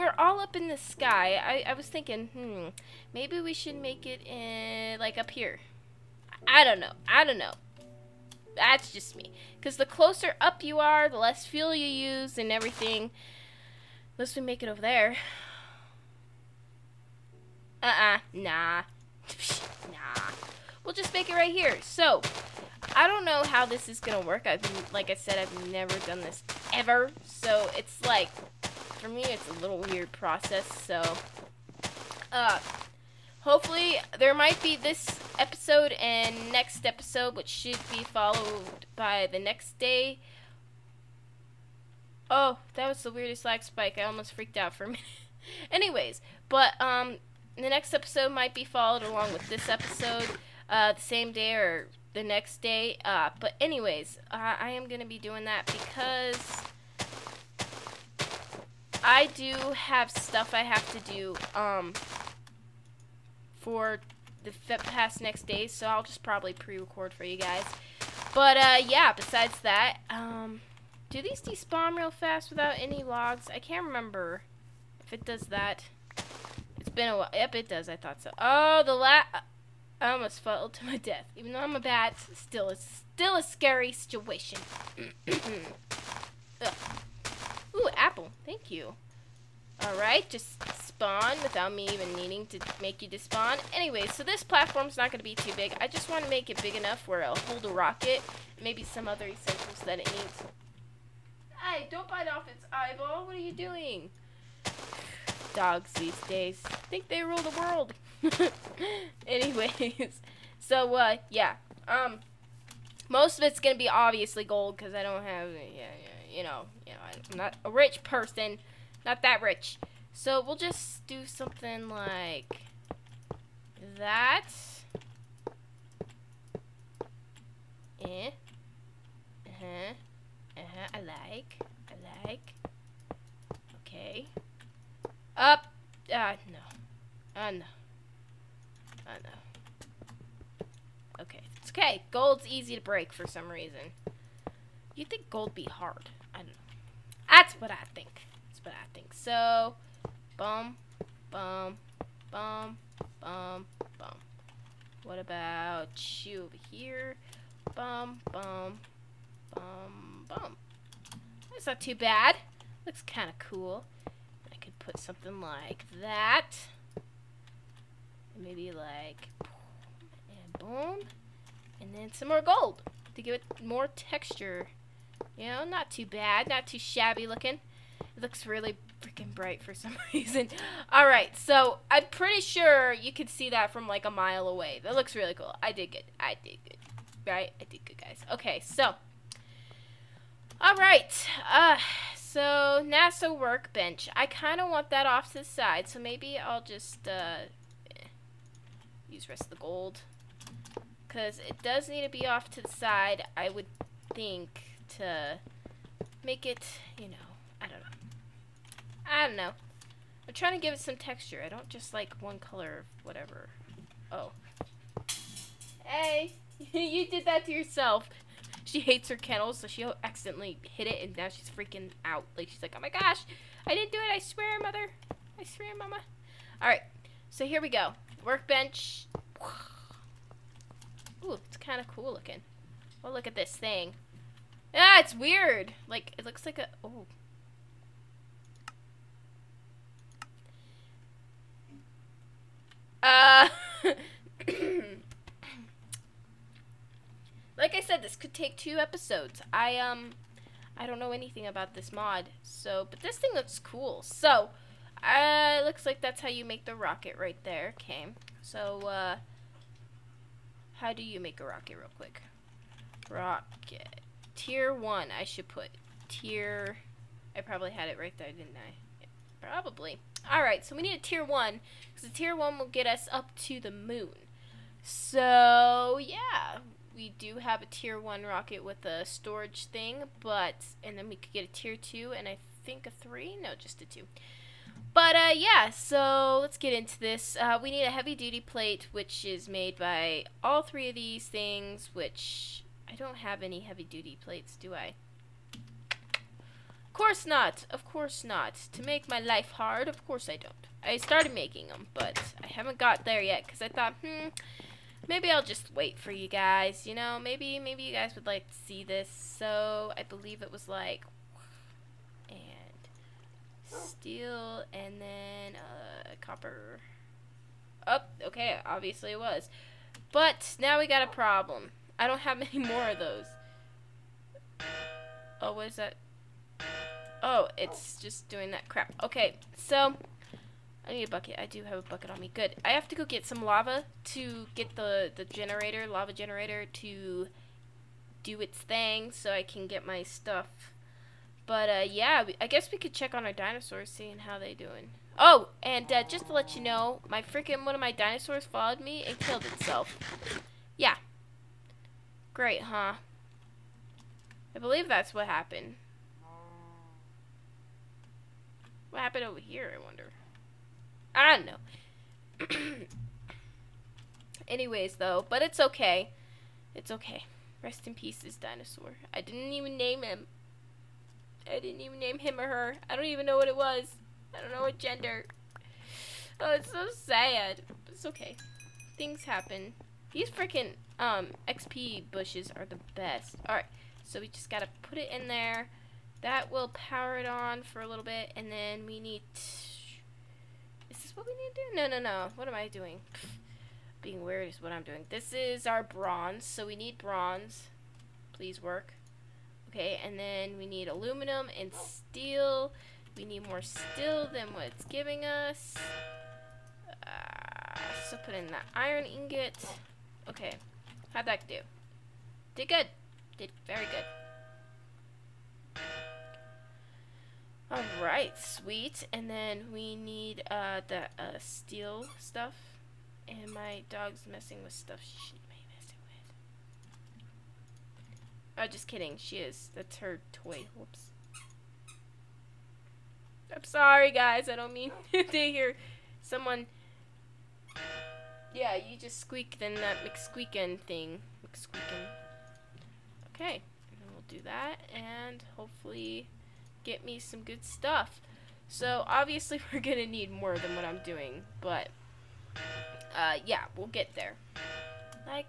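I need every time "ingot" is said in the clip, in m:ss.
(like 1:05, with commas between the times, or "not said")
6:49.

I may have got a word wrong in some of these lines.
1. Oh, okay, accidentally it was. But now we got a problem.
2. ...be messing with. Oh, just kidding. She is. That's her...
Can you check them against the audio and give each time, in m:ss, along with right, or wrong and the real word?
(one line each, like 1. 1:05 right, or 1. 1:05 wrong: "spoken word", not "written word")
1. 5:17 wrong: "obviously", not "accidentally"
2. 7:05 right.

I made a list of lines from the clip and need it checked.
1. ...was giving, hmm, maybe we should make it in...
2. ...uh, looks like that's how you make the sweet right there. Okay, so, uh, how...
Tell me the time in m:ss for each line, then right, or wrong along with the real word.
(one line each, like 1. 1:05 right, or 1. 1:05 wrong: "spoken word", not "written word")
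1. 0:01 wrong: "thinking", not "giving"
2. 4:15 wrong: "rocket", not "sweet".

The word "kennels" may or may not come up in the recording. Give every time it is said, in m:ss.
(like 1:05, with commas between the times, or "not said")
3:39.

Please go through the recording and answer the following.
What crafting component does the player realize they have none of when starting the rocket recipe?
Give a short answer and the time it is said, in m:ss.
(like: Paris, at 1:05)
heavy duty plate, at 4:47.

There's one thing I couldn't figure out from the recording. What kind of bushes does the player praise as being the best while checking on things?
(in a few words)
XP bushes.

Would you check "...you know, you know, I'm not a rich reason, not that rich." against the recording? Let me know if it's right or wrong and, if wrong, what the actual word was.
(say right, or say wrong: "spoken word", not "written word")
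wrong: "person", not "reason".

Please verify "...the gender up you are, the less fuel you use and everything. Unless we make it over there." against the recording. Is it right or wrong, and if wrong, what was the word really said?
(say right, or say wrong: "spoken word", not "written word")
wrong: "closer", not "gender".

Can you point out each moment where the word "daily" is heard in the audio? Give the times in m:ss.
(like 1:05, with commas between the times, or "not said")
not said.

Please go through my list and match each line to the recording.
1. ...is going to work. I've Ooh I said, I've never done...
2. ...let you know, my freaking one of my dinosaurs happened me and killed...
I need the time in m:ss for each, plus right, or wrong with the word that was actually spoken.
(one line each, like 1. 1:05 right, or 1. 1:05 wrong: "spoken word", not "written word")
1. 0:23 wrong: "Like", not "Ooh"
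2. 5:46 wrong: "followed", not "happened".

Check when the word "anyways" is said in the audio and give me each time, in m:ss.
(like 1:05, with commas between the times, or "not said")
0:45, 0:53, 1:33, 1:49, 6:04.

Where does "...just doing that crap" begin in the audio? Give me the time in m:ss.
5:27.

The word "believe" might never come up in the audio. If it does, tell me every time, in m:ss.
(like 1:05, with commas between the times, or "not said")
5:10, 5:54.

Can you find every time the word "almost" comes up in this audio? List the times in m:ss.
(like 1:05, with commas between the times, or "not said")
0:44, 1:20.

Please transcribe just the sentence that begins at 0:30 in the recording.
So, uh, hopefully there might be this episode and next episode, which should be followed by the next day.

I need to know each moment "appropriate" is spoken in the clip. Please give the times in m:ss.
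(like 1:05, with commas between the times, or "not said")
not said.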